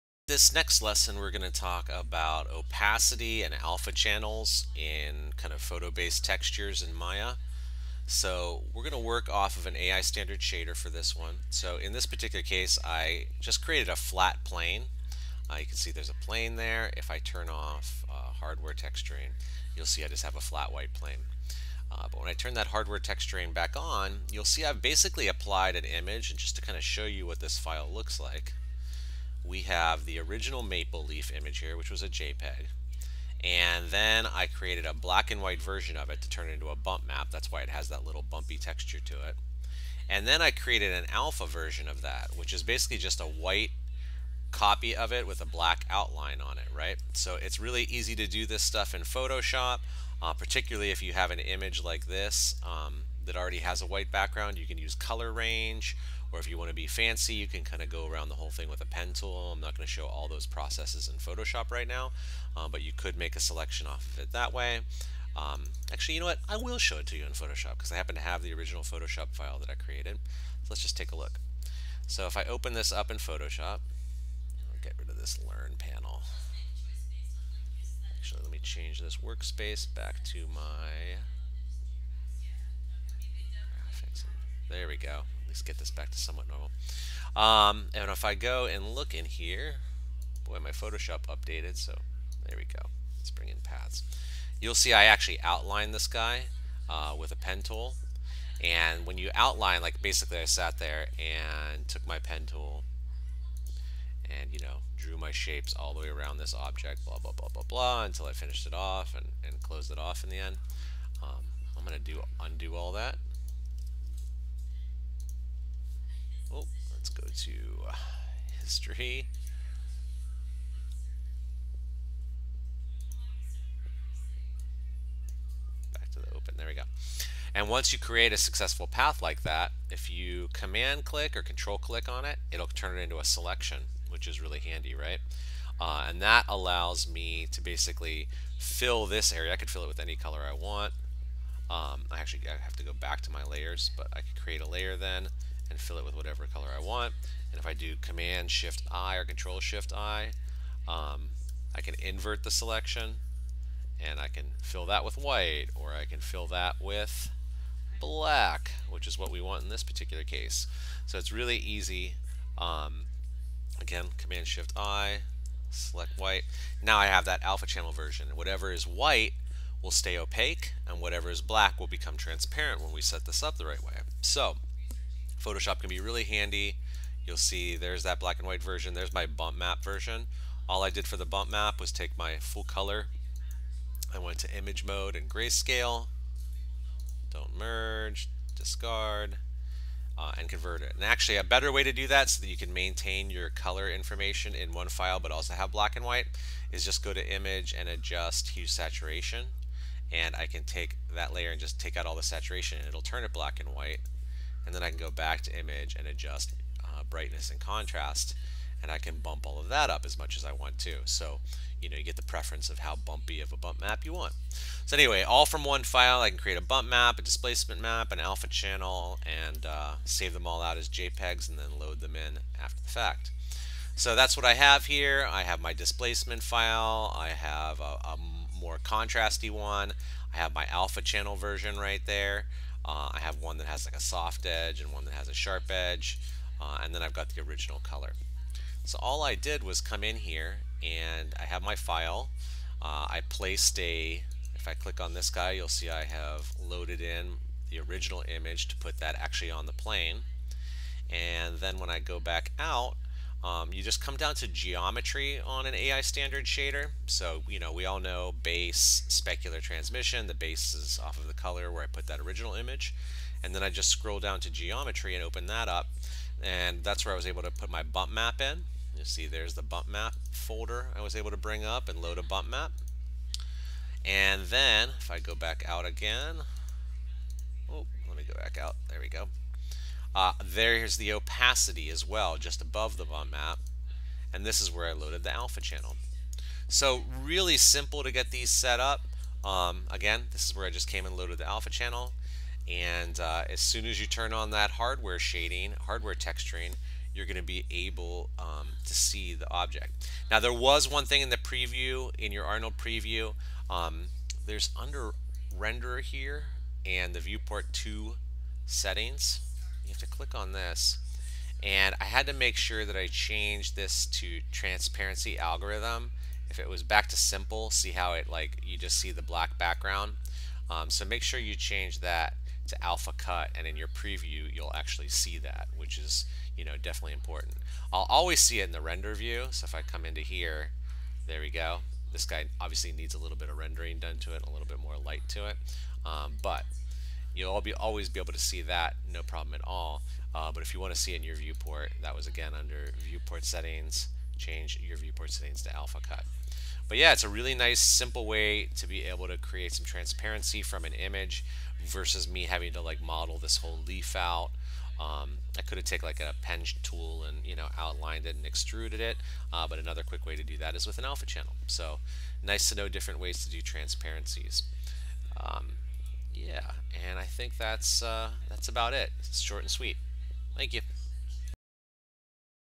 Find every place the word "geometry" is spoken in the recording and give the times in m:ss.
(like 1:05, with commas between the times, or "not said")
4:14, 4:24.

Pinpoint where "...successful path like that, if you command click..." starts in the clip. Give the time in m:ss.
2:08.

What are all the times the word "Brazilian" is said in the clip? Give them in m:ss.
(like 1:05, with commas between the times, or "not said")
not said.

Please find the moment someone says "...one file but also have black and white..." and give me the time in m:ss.
3:14.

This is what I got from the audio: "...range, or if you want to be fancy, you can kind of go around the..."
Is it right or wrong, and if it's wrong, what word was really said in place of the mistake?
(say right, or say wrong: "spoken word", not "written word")
right.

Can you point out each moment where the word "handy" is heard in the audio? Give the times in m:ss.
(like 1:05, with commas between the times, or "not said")
2:14, 2:56.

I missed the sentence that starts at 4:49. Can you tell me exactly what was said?
Um, again, this is where I just came and loaded the alpha channel.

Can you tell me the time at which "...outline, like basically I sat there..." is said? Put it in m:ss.
1:39.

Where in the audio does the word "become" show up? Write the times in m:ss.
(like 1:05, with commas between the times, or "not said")
2:51.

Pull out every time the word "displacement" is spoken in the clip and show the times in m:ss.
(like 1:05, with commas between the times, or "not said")
3:37, 3:45.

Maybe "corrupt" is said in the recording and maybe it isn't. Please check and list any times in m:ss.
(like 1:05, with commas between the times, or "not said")
not said.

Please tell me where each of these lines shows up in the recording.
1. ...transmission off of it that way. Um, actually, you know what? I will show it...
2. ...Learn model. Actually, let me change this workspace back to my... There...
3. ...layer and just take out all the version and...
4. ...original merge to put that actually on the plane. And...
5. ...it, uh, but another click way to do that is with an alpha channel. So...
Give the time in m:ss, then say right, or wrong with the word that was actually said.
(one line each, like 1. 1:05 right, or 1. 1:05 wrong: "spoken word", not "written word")
1. 1:03 wrong: "selection", not "transmission"
2. 1:15 wrong: "panel", not "model"
3. 3:21 wrong: "saturation", not "version"
4. 4:07 wrong: "image", not "merge"
5. 5:58 wrong: "quick", not "click".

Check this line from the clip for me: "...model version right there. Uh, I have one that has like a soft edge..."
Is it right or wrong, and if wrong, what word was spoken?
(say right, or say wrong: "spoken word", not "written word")
wrong: "channel", not "model".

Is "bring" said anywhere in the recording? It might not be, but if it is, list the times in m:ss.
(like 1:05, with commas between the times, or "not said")
1:33, 4:31.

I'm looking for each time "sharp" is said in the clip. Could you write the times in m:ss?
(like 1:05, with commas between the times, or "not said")
3:55.